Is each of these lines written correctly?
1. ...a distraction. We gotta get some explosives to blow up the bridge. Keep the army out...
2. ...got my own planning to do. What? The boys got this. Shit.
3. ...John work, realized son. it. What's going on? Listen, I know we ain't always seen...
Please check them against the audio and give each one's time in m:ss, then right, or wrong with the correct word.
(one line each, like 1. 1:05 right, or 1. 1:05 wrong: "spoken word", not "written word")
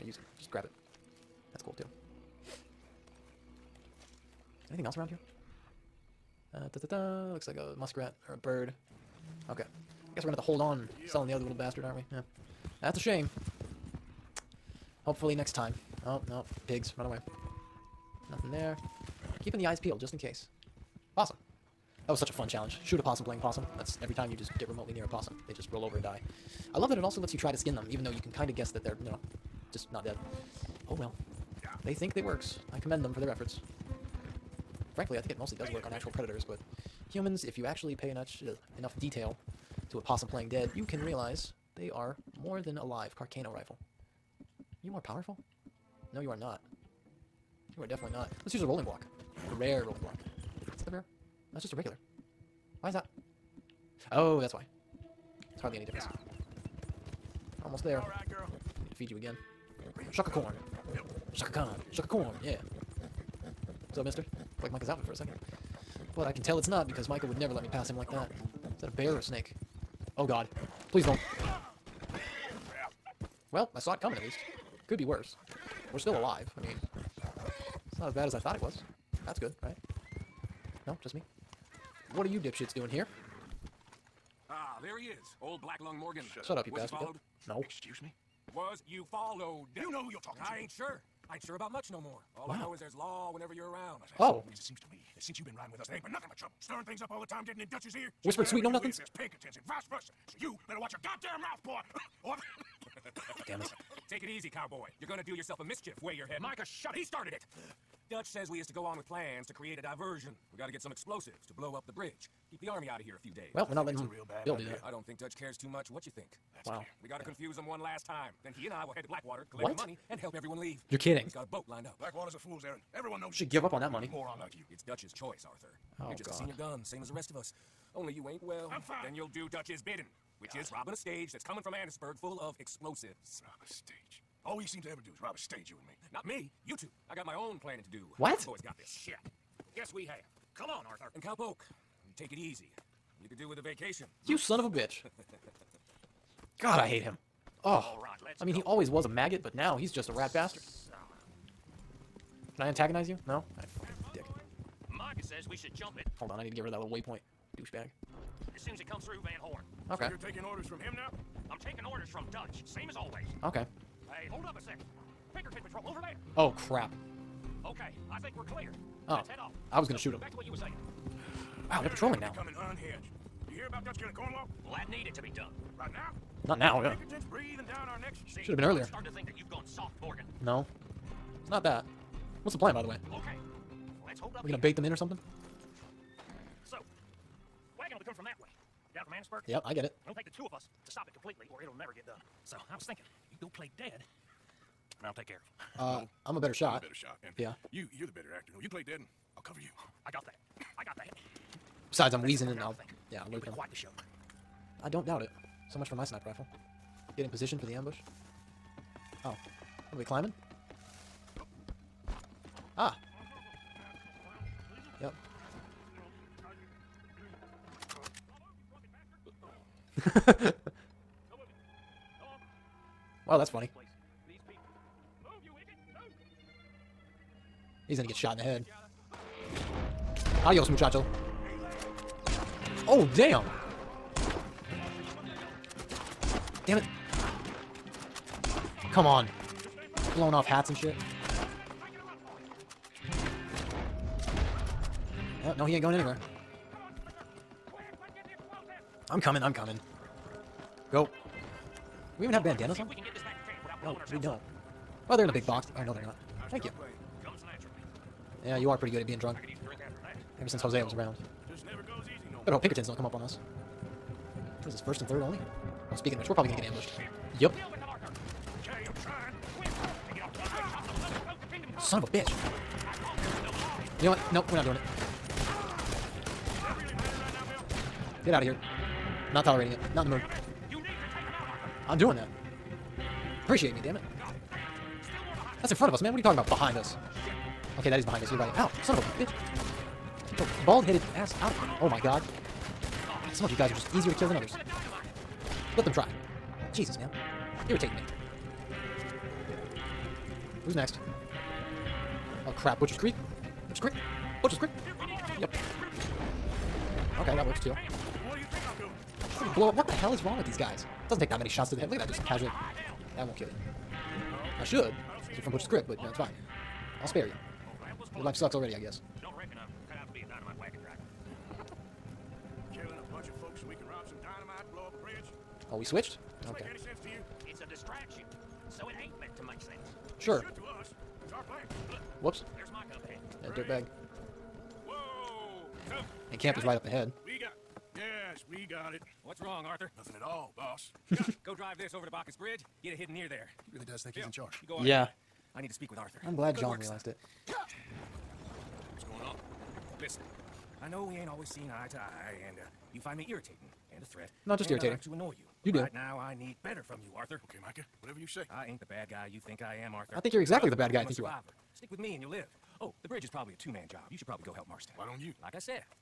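1. 1:49 wrong: "diversion", not "distraction"
2. 2:17 right
3. 5:46 right.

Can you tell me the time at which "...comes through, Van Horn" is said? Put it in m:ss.
2:38.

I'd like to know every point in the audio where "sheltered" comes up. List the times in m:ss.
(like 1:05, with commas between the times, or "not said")
not said.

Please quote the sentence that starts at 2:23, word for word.
You could do with a vacation.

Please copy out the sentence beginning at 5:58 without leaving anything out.
I ain't the bad guy you think I am, Arthur.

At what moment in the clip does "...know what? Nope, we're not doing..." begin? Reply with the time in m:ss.
4:34.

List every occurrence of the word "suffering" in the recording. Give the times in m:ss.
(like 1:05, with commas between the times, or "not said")
not said.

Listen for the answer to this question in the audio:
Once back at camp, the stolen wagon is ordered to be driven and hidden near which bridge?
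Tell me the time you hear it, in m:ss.
5:42.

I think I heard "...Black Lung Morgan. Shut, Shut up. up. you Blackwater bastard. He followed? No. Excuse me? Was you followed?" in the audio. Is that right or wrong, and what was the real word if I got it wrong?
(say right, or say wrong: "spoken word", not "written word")
wrong: "Was", not "Blackwater".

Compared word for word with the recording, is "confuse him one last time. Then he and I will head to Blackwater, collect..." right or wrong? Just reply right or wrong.
right.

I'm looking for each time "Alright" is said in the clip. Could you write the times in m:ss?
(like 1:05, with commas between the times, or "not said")
2:33.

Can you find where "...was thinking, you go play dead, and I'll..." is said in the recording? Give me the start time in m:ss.
3:12.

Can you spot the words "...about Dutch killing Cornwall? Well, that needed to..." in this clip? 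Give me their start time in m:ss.
2:53.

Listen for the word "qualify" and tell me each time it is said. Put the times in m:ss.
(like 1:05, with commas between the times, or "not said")
not said.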